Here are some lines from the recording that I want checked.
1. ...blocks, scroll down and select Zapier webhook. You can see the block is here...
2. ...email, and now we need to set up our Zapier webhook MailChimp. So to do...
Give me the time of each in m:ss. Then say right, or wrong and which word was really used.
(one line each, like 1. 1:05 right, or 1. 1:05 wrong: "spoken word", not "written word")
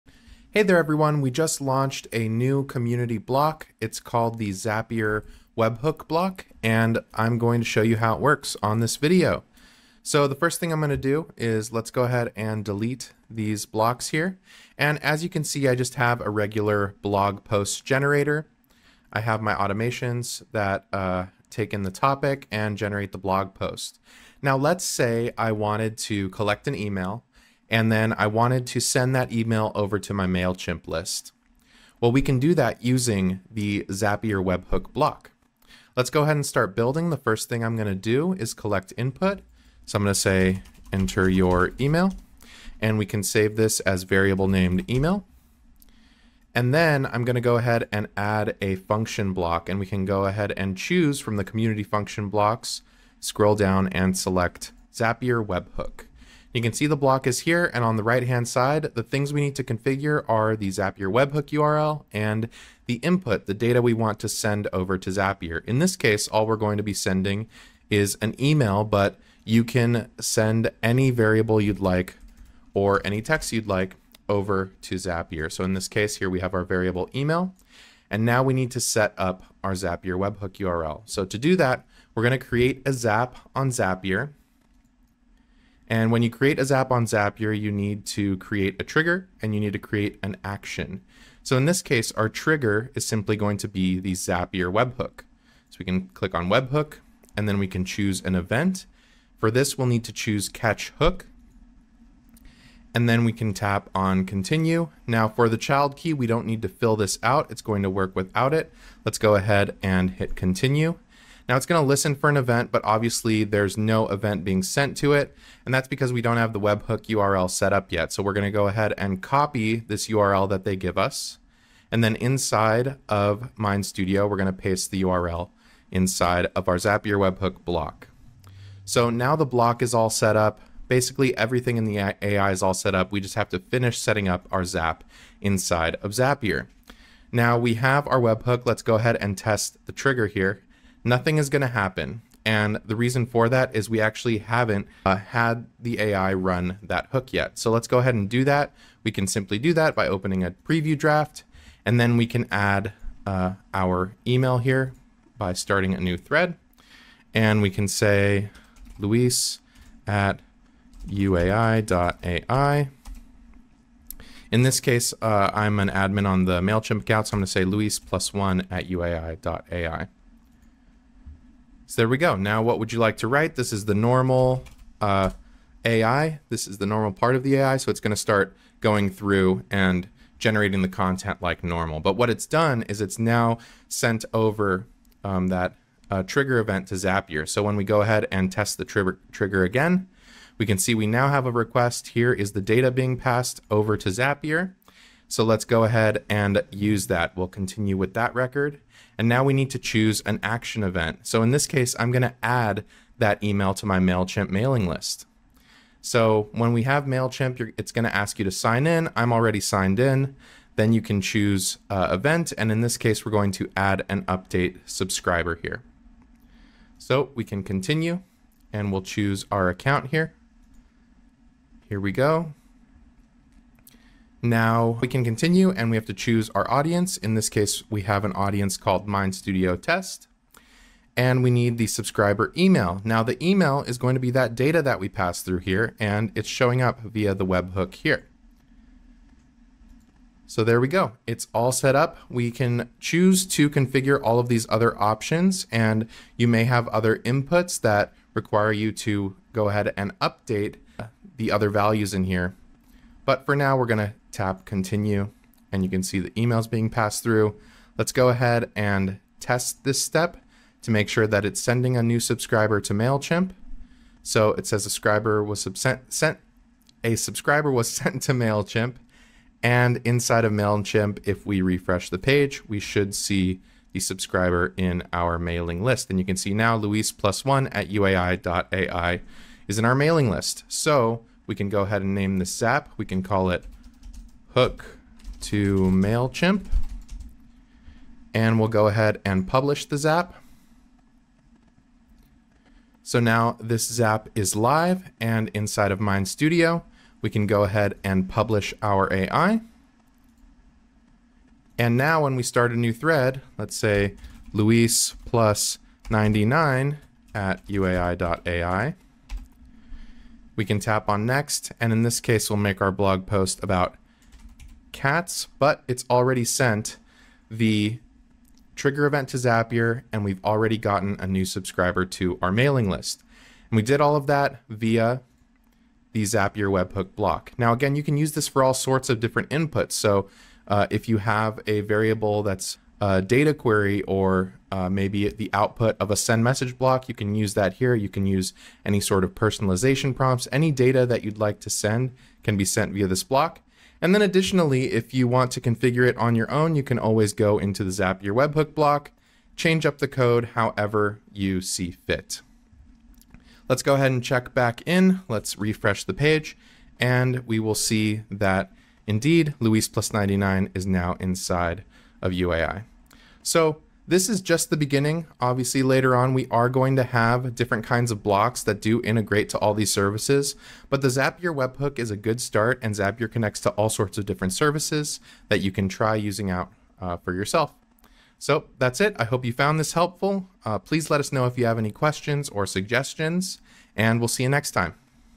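1. 0:52 right
2. 1:17 wrong: "URL", not "MailChimp".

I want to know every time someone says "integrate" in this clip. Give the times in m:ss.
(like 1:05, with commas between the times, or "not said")
6:09.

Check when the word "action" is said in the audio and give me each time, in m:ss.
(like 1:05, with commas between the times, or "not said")
1:30, 3:20.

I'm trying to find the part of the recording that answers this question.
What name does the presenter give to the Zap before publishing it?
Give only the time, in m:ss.
4:44.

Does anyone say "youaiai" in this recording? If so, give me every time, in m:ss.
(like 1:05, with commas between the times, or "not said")
2:41, 2:48, 4:37, 5:07.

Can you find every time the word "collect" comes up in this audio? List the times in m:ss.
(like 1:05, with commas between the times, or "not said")
0:26, 0:38.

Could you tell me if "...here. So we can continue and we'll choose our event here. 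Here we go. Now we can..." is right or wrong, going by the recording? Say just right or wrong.
wrong.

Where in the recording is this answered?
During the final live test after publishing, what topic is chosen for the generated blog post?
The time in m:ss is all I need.
5:14.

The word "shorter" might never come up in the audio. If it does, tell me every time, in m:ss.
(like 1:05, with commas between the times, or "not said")
not said.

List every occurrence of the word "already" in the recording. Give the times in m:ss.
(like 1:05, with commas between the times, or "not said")
3:29, 5:16, 5:20.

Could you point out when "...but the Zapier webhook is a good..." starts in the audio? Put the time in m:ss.
6:10.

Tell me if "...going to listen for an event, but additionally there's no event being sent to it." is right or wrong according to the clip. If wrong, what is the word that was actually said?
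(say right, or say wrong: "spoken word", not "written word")
wrong: "obviously", not "additionally".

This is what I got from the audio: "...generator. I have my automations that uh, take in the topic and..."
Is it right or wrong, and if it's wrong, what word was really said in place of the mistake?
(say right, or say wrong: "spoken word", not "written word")
right.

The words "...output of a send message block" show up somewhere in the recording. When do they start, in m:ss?
5:35.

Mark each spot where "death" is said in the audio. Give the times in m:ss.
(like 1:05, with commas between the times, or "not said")
not said.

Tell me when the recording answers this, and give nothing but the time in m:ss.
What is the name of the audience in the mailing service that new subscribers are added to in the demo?
3:49.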